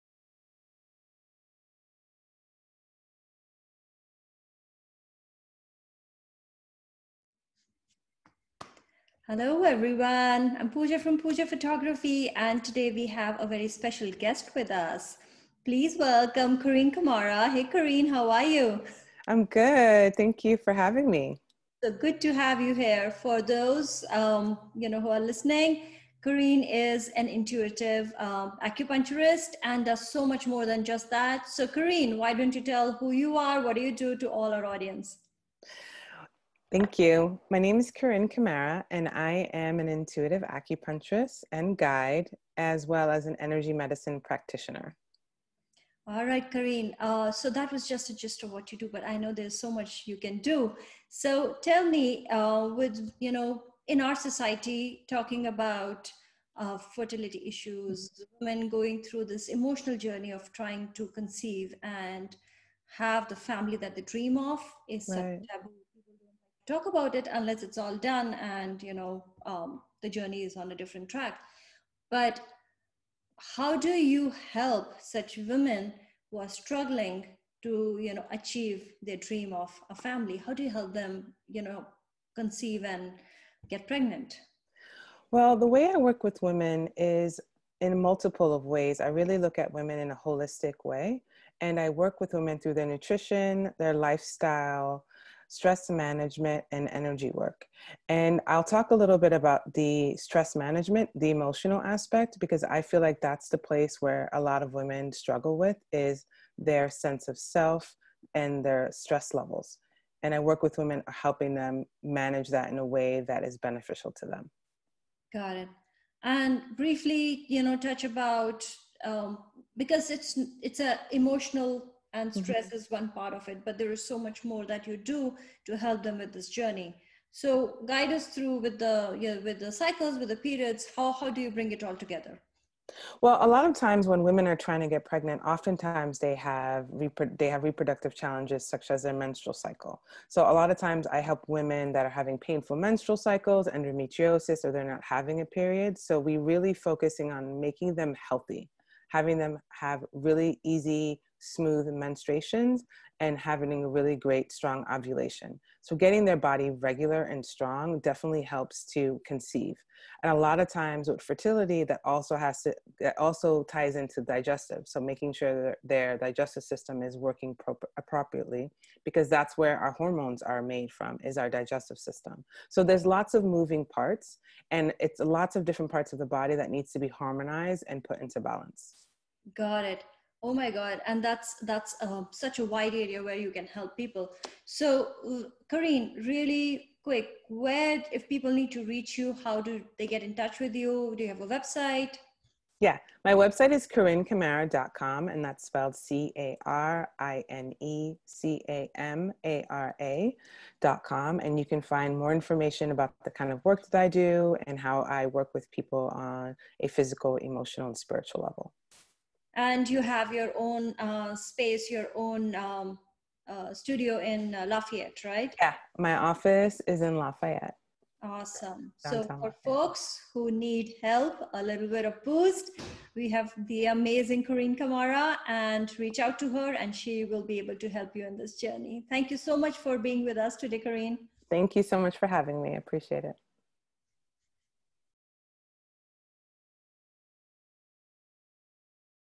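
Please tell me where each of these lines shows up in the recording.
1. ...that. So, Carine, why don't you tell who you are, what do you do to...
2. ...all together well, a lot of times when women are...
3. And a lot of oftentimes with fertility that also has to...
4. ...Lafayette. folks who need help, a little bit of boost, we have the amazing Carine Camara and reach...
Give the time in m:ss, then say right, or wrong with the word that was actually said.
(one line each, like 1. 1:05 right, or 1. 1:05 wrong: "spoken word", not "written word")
1. 0:31 right
2. 2:11 right
3. 2:40 wrong: "times", not "oftentimes"
4. 3:39 right.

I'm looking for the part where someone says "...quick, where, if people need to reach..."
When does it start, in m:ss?
3:07.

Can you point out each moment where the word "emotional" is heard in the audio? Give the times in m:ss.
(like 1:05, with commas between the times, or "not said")
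0:59, 1:41, 2:01, 3:27.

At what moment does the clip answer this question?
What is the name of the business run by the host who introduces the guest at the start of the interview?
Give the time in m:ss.
0:11.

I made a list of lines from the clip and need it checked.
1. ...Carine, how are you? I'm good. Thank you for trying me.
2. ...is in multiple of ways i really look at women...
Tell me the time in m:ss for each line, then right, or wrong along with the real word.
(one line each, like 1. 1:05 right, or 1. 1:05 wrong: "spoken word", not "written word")
1. 0:17 wrong: "having", not "trying"
2. 1:26 right.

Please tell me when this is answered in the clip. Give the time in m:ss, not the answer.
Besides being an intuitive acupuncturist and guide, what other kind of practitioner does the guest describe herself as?
0:43.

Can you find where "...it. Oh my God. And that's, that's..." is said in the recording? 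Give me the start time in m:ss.
2:59.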